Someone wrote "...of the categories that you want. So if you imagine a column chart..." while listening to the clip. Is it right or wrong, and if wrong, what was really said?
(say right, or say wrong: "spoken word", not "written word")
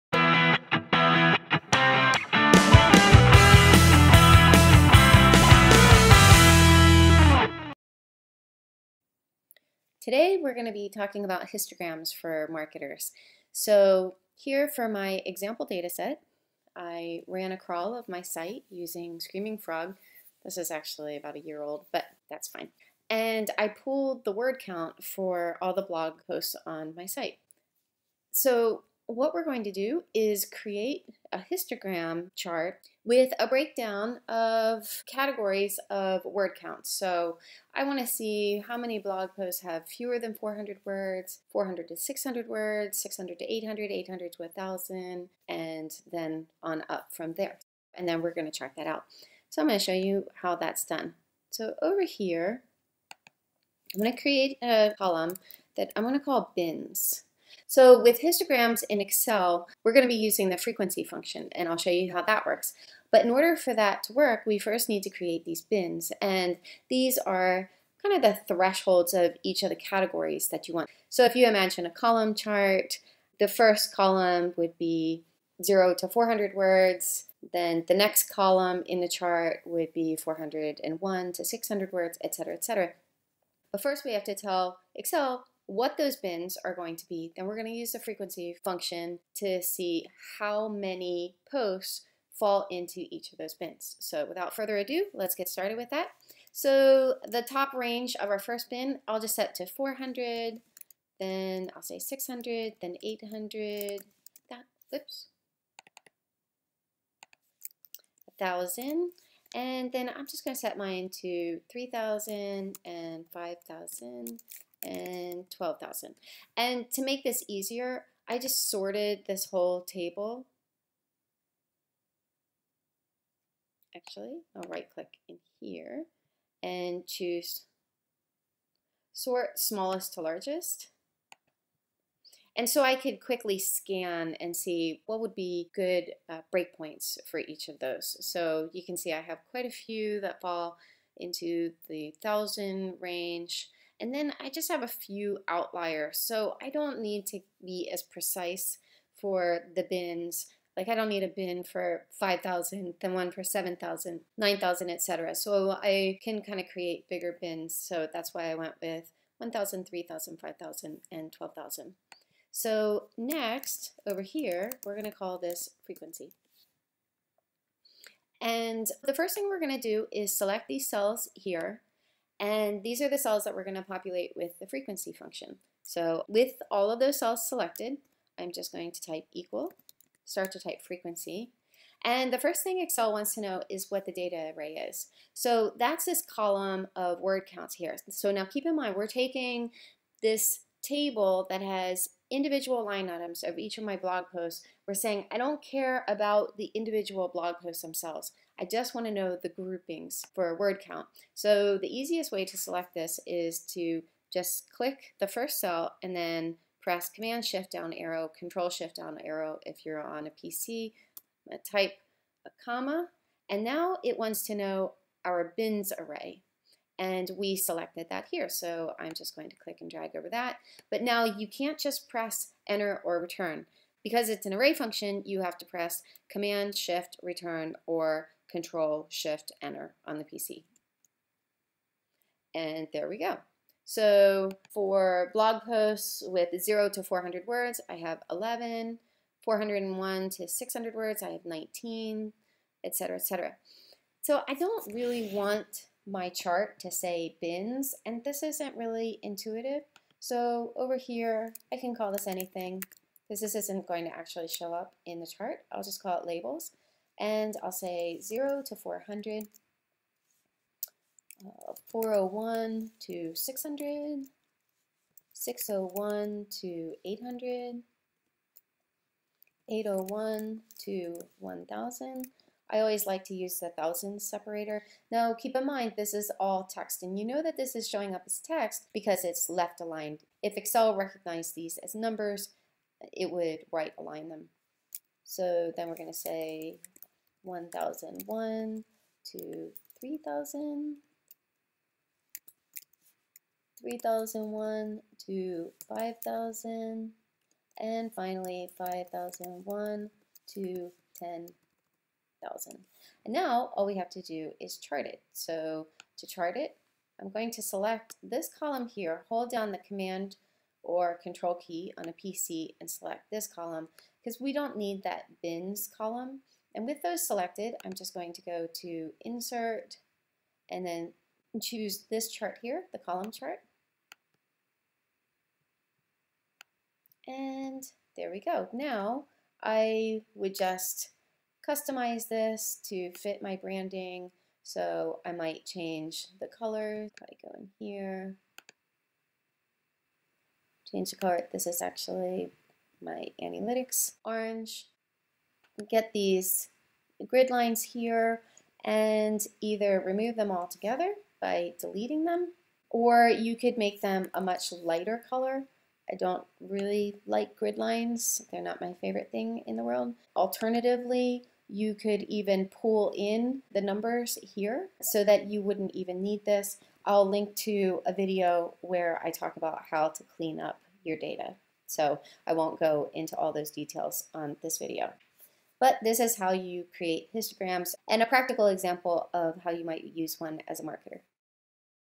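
right.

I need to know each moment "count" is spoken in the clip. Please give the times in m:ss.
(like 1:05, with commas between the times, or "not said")
0:24, 0:36, 3:07, 3:20.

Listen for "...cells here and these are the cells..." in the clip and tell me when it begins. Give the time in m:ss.
2:50.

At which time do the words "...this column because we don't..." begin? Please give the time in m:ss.
5:13.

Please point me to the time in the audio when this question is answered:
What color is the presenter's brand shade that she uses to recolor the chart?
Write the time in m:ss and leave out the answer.
5:44.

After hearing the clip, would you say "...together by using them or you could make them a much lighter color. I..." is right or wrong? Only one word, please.
wrong.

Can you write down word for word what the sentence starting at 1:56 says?
And to make this easier, I just sorted this whole table.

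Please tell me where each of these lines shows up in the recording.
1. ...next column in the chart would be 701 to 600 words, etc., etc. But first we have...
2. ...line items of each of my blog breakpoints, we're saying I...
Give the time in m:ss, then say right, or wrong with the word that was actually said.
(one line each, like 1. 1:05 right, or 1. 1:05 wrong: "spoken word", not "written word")
1. 1:17 wrong: "401", not "701"
2. 3:12 wrong: "posts", not "breakpoints".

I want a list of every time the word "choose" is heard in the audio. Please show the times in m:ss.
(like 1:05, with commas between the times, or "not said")
2:07, 5:21.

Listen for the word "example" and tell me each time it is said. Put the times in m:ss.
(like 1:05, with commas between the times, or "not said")
0:15, 6:18.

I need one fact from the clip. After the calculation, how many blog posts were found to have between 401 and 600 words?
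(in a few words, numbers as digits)
19.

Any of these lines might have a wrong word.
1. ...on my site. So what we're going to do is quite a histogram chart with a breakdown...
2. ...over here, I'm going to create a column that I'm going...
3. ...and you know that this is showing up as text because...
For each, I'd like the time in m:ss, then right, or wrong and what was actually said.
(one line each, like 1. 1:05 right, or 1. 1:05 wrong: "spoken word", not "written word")
1. 0:26 wrong: "create", not "quite"
2. 0:51 right
3. 4:37 right.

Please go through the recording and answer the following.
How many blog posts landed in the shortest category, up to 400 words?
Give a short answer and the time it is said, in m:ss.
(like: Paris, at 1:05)
11, at 3:58.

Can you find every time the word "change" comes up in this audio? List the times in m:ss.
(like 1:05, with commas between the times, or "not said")
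5:35, 5:40.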